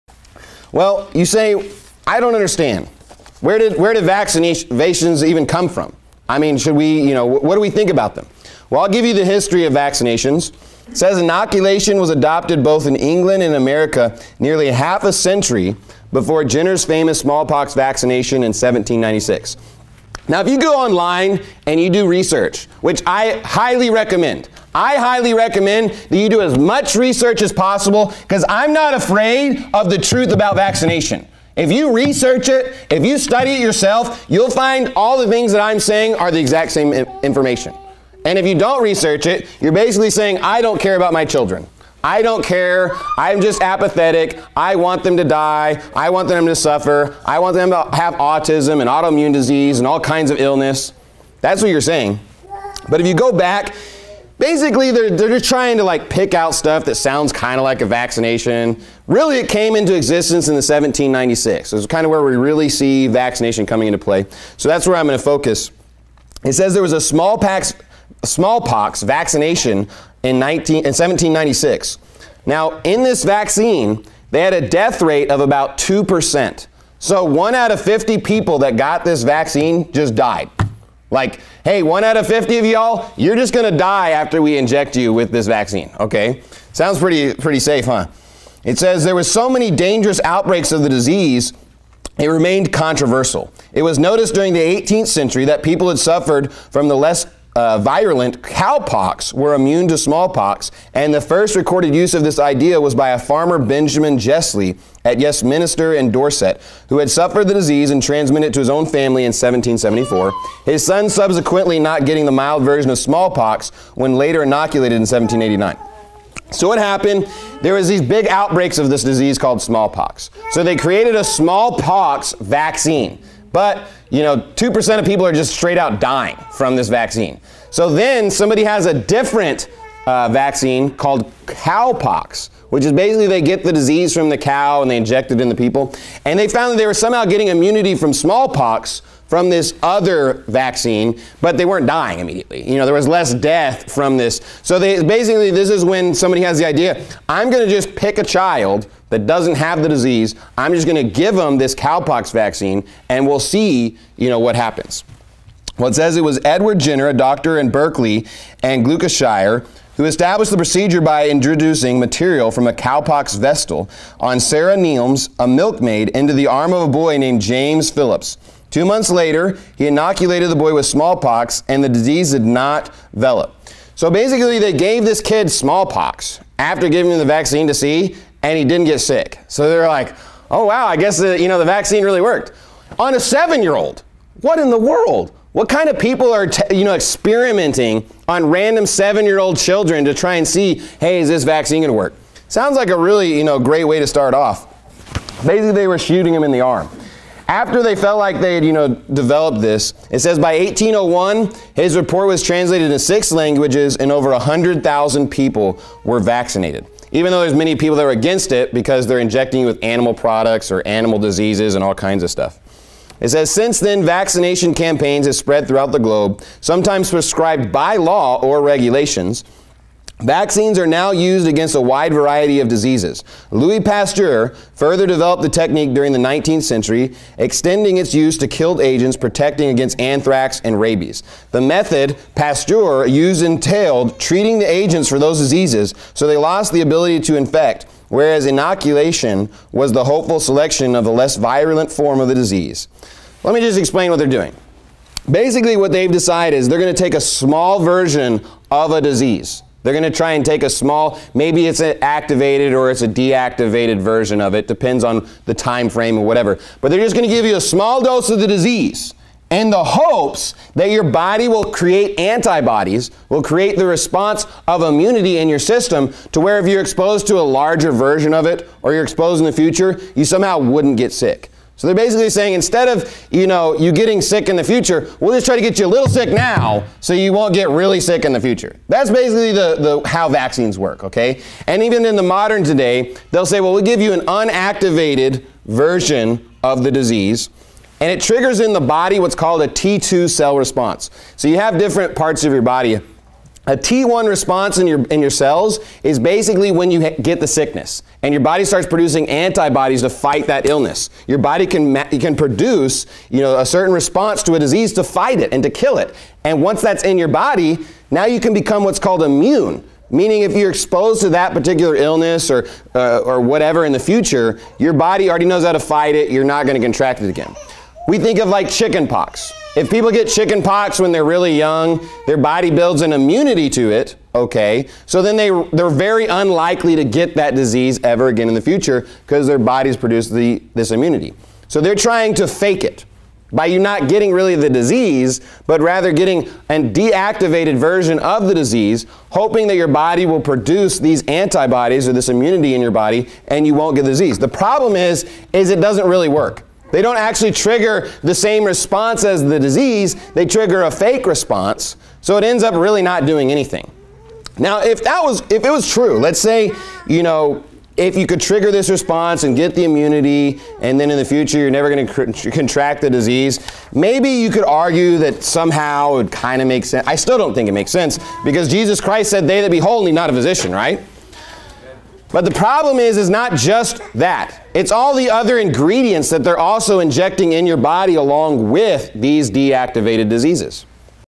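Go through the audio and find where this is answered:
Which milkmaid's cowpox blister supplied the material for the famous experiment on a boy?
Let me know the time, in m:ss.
2:44.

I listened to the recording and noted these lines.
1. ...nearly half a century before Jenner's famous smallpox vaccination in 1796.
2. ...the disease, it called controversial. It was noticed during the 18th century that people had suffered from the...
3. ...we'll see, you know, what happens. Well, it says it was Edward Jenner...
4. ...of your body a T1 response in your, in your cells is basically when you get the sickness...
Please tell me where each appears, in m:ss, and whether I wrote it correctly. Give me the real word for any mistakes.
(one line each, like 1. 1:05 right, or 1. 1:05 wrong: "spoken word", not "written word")
1. 0:14 right
2. 1:30 wrong: "remained", not "called"
3. 2:33 right
4. 4:52 right.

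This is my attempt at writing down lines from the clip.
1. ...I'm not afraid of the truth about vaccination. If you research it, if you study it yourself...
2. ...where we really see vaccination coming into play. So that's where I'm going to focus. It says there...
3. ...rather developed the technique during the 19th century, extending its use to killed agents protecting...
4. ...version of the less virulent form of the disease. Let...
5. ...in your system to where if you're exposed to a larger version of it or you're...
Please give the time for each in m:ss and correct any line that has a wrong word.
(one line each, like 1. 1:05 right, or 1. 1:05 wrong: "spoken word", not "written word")
1. 0:28 right
2. 1:02 right
3. 3:44 wrong: "further", not "rather"
4. 4:00 wrong: "selection", not "version"
5. 4:25 right.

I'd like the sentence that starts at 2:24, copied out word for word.
So they basically this is when somebody has the idea, I'm going to just pick a child that doesn't have the disease.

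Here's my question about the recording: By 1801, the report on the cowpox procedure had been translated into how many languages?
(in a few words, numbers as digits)
6.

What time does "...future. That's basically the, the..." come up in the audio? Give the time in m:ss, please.
4:38.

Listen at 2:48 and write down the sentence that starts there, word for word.
Two months later, he inoculated the boy with smallpox, and the disease did not develop.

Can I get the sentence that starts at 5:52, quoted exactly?
So it ends up really not doing anything.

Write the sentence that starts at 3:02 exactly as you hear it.
On a seven year old, what in the world?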